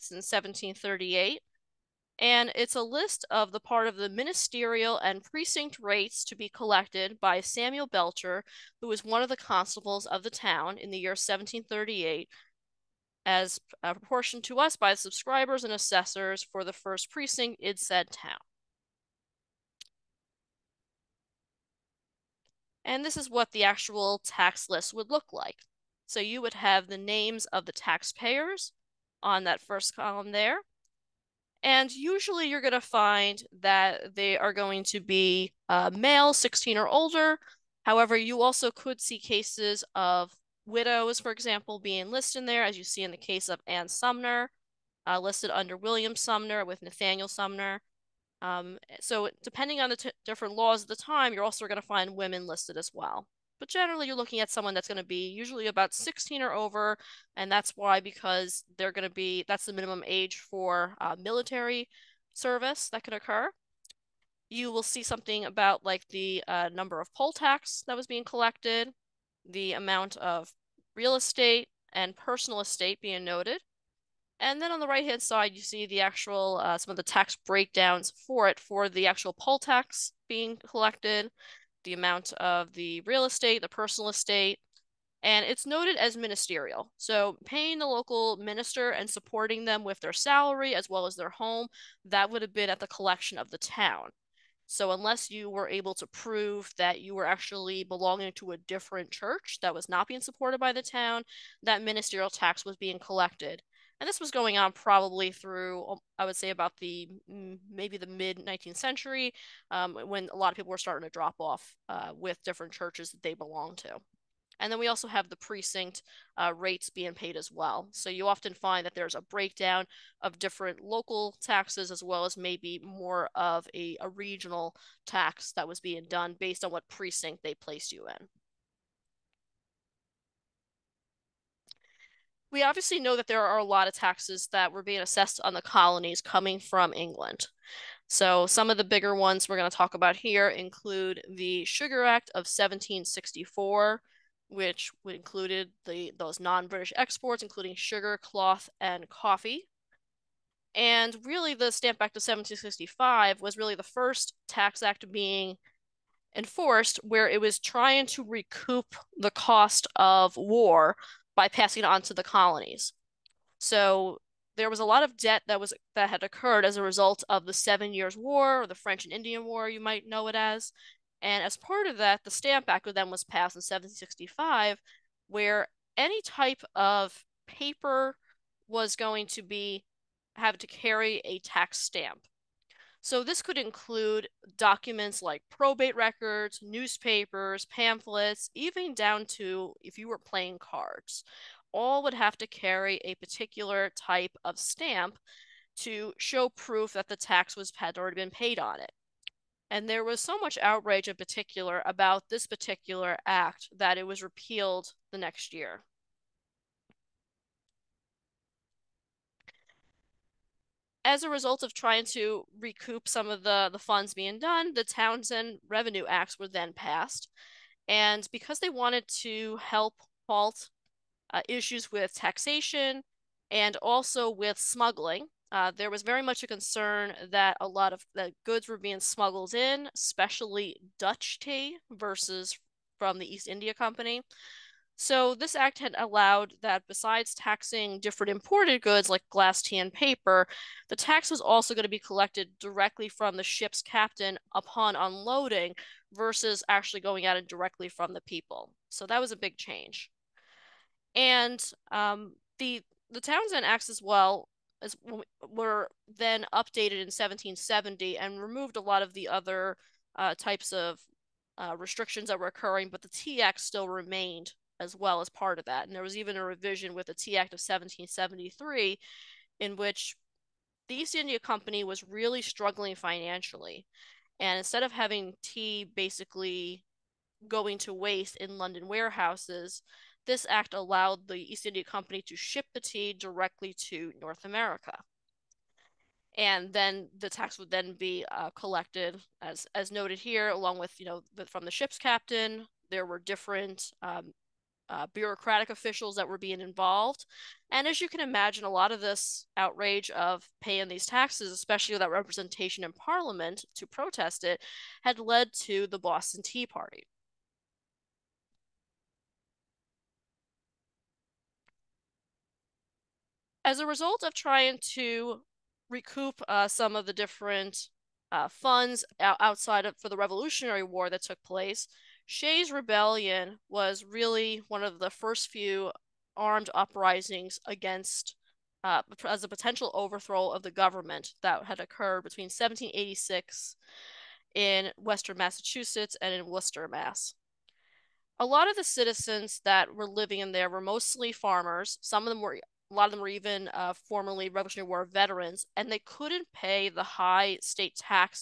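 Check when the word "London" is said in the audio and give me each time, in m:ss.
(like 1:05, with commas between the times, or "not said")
4:38.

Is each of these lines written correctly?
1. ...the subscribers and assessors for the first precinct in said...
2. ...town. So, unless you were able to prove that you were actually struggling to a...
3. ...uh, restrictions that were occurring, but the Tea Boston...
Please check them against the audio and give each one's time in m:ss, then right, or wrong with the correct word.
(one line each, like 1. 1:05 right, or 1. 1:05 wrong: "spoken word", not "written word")
1. 0:14 right
2. 1:33 wrong: "belonging", not "struggling"
3. 4:21 wrong: "Act", not "Boston".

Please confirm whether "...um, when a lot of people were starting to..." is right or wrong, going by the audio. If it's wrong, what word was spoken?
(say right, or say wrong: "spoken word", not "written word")
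right.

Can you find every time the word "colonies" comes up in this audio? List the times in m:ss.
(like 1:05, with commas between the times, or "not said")
2:15, 2:42.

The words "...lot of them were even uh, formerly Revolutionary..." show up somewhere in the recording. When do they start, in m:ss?
5:42.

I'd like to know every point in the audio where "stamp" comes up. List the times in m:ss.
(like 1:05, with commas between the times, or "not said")
2:31, 2:52, 3:01, 3:14.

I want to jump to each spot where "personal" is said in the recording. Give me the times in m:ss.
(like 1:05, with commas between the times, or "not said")
1:12, 1:23.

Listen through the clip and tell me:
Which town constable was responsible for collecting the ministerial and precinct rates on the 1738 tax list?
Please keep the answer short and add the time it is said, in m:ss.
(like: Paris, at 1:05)
Samuel Belcher, at 0:07.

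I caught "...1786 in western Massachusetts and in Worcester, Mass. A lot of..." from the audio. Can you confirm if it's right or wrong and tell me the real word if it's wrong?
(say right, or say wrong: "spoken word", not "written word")
right.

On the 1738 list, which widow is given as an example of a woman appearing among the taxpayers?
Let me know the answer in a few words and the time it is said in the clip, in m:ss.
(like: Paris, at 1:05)
Ann Sumner, at 0:43.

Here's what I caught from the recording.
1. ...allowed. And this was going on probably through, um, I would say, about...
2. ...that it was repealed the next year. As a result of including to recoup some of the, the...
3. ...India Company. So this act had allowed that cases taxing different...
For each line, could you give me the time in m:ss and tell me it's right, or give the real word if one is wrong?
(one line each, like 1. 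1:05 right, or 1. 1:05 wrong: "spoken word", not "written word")
1. 1:42 wrong: "collected", not "allowed"
2. 3:23 wrong: "trying", not "including"
3. 3:53 wrong: "besides", not "cases".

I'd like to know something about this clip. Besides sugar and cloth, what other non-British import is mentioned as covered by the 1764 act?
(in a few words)
coffee.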